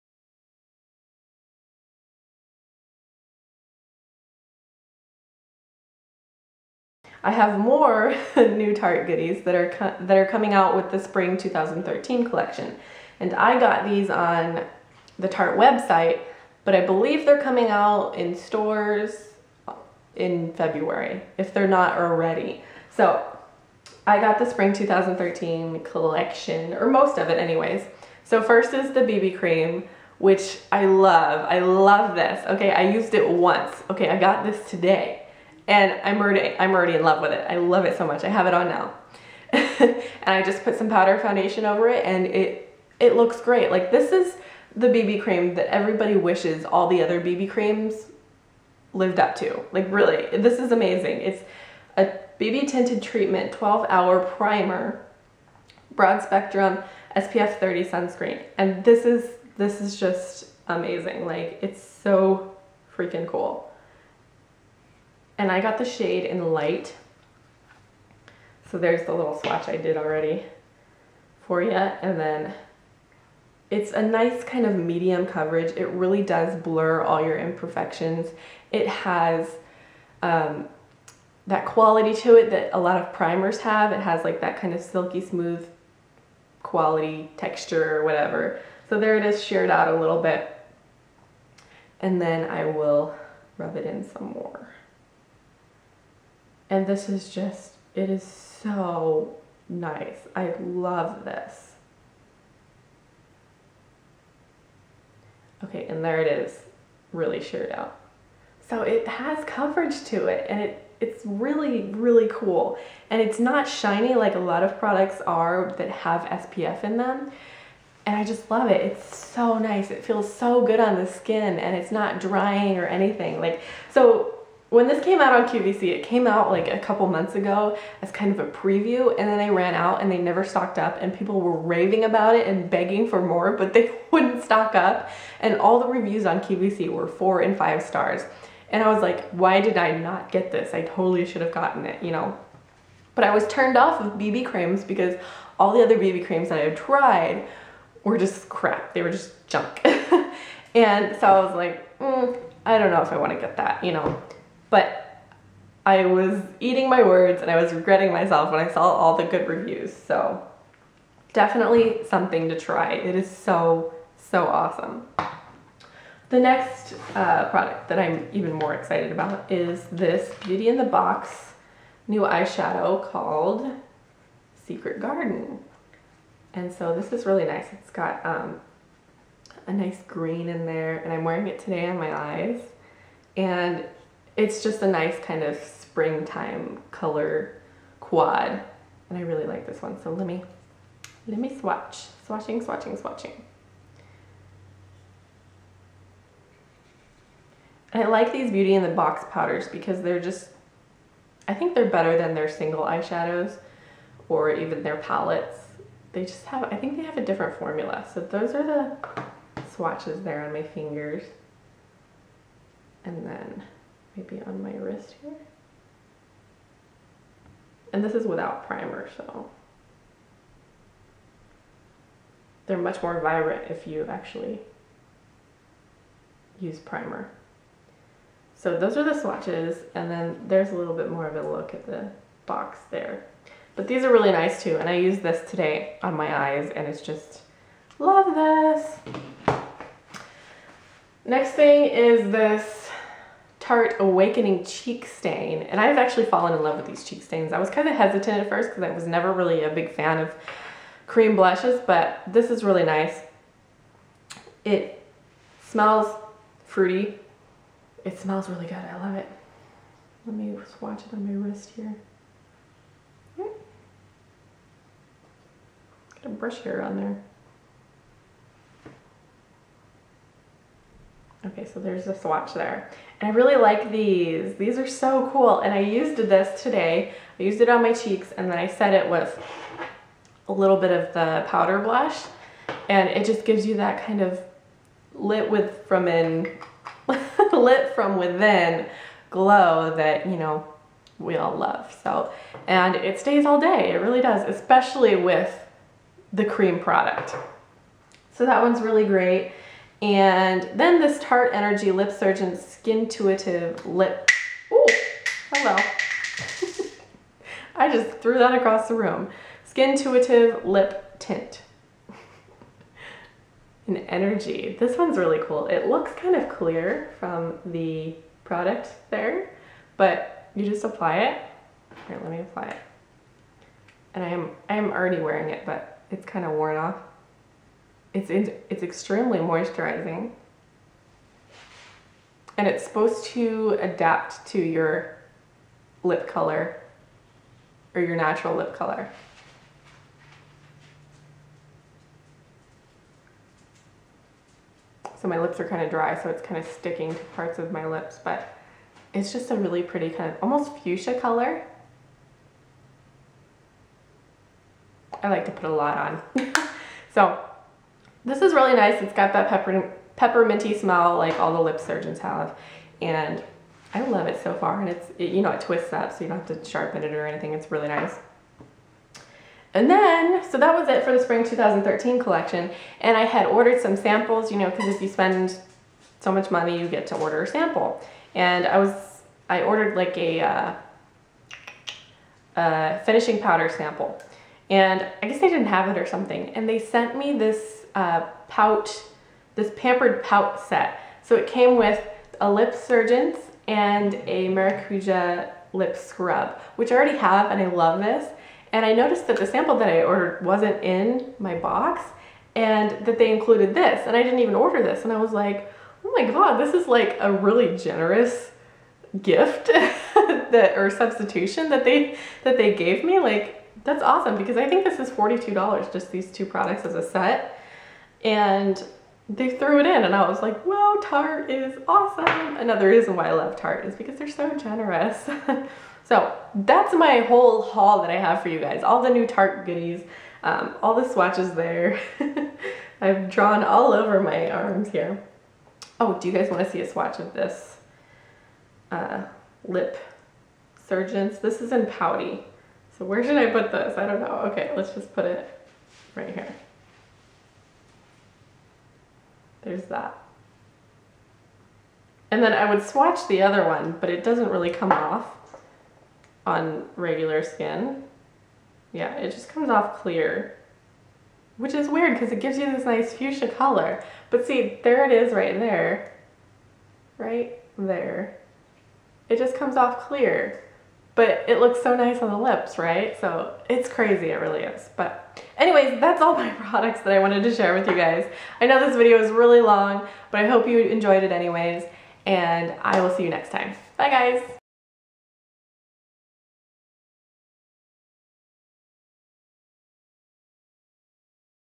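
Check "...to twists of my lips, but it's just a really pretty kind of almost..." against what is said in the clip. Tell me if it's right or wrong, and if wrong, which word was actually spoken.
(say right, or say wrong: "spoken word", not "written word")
wrong: "parts", not "twists".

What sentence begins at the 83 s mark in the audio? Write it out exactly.
It has like that kind of silky smooth quality texture or whatever.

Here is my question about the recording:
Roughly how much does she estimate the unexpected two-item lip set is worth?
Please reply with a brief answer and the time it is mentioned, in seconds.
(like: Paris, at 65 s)
$42, at 415 s.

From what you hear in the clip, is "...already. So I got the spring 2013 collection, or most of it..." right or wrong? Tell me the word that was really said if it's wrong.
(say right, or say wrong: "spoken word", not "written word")
right.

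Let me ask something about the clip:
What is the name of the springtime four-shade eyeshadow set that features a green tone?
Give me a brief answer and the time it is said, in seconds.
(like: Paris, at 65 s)
Secret Garden, at 174 s.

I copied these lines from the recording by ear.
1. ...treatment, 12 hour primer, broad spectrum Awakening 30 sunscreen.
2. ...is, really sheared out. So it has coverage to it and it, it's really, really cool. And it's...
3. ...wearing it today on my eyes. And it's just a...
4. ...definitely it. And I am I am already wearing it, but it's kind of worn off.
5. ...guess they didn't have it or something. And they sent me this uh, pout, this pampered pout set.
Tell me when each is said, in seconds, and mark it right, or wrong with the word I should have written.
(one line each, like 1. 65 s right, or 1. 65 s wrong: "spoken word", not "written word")
1. 53 s wrong: "SPF", not "Awakening"
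2. 106 s right
3. 181 s right
4. 322 s wrong: "apply", not "definitely"
5. 385 s right.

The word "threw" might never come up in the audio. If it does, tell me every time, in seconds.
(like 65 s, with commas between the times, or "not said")
308 s, 419 s.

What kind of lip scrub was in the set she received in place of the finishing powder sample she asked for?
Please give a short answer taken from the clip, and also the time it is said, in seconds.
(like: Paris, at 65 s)
Maracuja, at 394 s.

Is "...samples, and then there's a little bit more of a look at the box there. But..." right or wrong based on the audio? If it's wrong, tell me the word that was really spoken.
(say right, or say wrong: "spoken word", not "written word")
wrong: "swatches", not "samples".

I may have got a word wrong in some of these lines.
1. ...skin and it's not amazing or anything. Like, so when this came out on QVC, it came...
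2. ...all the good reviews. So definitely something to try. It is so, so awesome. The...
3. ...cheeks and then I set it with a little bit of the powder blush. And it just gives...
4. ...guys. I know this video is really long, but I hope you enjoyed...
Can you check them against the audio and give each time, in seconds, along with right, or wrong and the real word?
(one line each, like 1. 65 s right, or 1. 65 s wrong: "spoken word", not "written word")
1. 121 s wrong: "drying", not "amazing"
2. 158 s right
3. 277 s right
4. 477 s right.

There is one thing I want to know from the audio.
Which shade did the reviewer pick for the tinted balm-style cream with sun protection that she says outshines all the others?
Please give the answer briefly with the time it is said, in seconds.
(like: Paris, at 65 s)
Light, at 66 s.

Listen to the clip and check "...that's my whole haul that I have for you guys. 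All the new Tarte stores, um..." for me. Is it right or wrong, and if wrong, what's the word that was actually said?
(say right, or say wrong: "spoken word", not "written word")
wrong: "goodies", not "stores".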